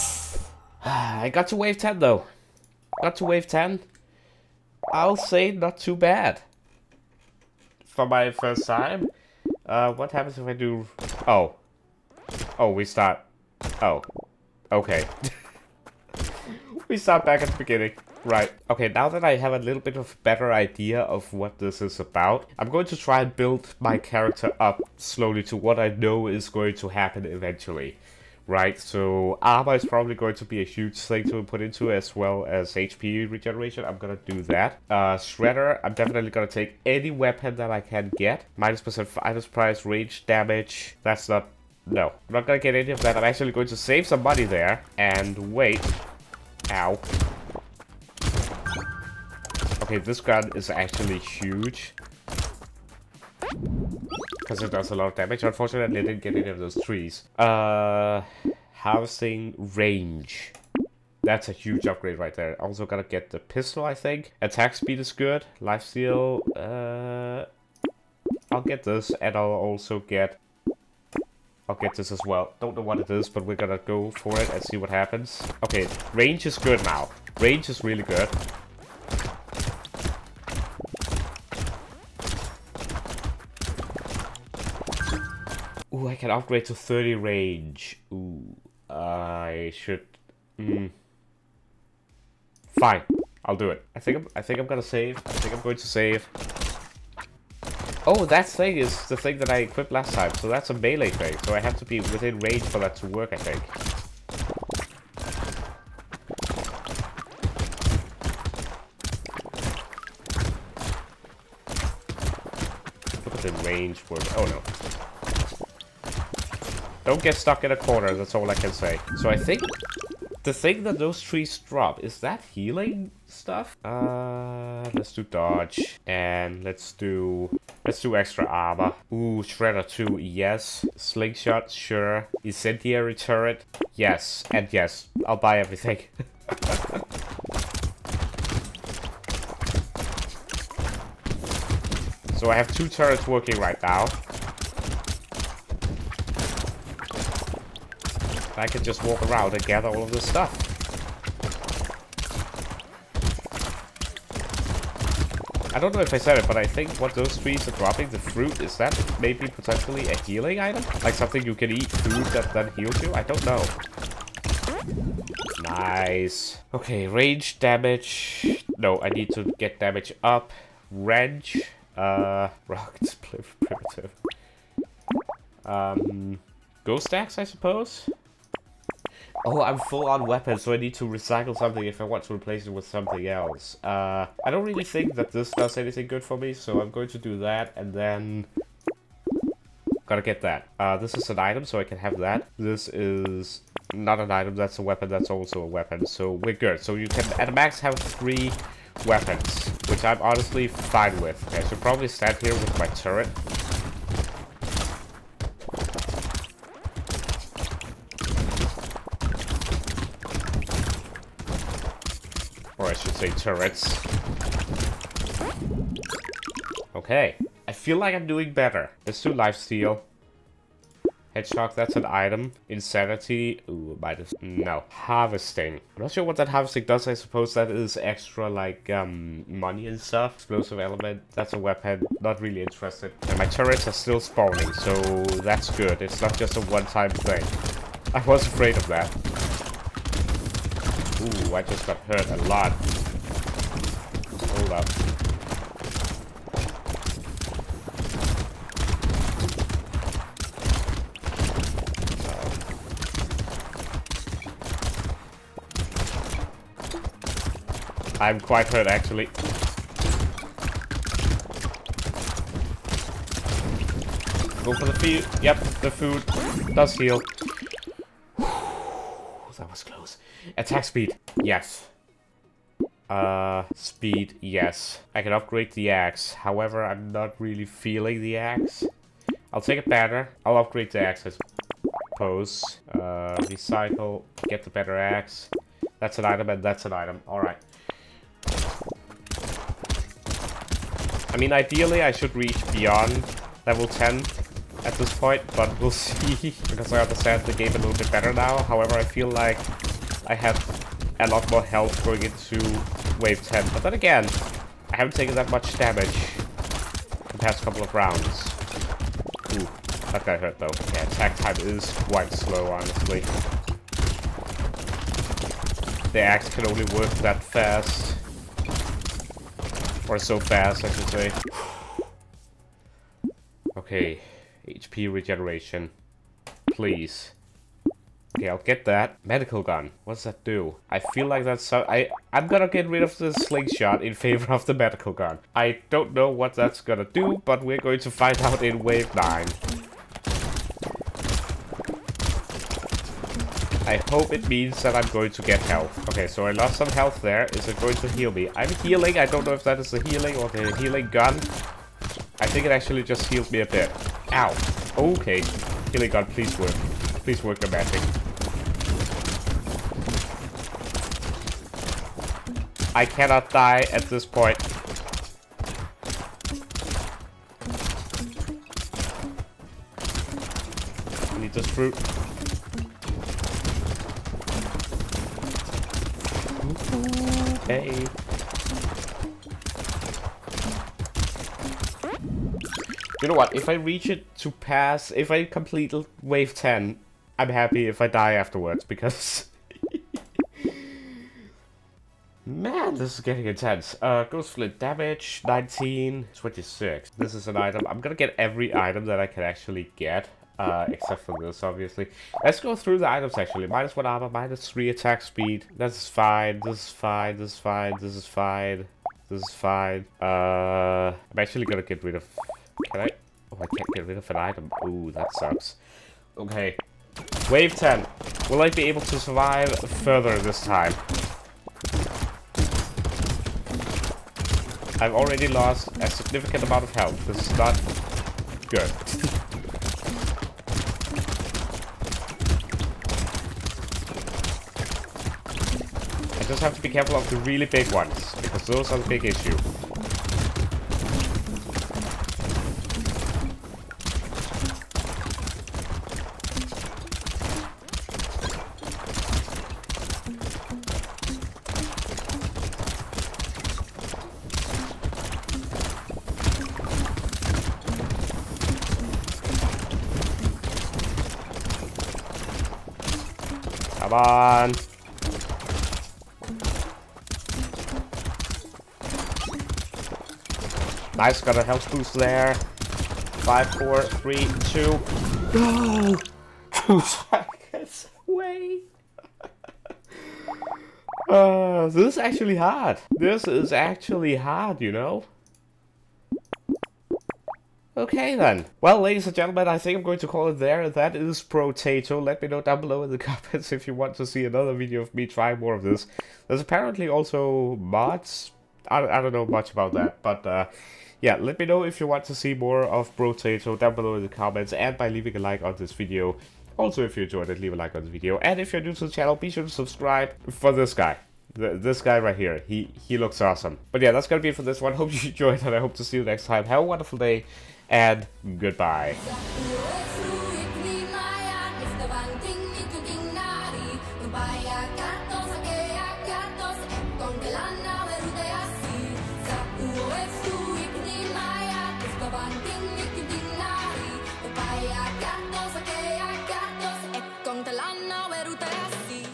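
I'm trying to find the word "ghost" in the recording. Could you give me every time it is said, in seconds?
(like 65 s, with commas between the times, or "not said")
176 s, 394 s.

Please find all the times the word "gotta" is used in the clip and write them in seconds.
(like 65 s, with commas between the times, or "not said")
62 s, 190 s.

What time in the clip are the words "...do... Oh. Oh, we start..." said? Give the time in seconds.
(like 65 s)
10 s.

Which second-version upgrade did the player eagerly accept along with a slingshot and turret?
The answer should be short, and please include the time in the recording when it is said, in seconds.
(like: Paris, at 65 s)
Shredder 2, at 129 s.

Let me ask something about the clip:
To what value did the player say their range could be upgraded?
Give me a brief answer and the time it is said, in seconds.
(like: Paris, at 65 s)
30, at 86 s.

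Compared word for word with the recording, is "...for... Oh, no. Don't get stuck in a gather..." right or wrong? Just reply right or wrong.
wrong.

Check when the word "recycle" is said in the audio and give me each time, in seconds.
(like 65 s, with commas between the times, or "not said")
181 s, 283 s.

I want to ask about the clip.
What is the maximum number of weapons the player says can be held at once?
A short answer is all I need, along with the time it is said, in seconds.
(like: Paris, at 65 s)
3, at 197 s.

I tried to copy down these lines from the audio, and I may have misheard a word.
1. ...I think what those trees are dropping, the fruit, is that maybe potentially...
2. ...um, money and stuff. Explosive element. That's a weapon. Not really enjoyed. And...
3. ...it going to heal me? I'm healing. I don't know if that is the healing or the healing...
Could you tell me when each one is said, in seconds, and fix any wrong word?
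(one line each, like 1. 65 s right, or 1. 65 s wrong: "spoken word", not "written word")
1. 156 s right
2. 228 s wrong: "interested", not "enjoyed"
3. 347 s right.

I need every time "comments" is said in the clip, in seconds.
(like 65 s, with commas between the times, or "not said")
493 s, 504 s.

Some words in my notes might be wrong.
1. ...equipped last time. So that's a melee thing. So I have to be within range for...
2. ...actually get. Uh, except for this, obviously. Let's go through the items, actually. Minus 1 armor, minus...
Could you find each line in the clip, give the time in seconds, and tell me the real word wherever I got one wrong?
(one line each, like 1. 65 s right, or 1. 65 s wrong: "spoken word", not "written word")
1. 99 s right
2. 399 s right.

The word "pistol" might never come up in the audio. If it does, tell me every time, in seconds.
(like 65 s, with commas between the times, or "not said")
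63 s.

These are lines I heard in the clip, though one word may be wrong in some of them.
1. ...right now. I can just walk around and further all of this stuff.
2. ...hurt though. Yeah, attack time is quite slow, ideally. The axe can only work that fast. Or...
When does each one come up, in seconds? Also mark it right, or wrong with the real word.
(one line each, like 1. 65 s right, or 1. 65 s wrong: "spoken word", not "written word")
1. 143 s wrong: "gather", not "further"
2. 310 s wrong: "honestly", not "ideally".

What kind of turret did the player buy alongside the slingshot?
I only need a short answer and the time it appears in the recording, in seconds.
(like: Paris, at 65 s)
Incendiary turret, at 132 s.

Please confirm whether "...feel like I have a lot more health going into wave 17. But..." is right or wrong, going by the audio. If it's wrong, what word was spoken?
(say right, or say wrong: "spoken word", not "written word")
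wrong: "10", not "17".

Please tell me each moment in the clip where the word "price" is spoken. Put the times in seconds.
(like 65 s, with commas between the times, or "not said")
39 s.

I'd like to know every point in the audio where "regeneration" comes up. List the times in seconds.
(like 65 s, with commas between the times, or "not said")
33 s, 325 s.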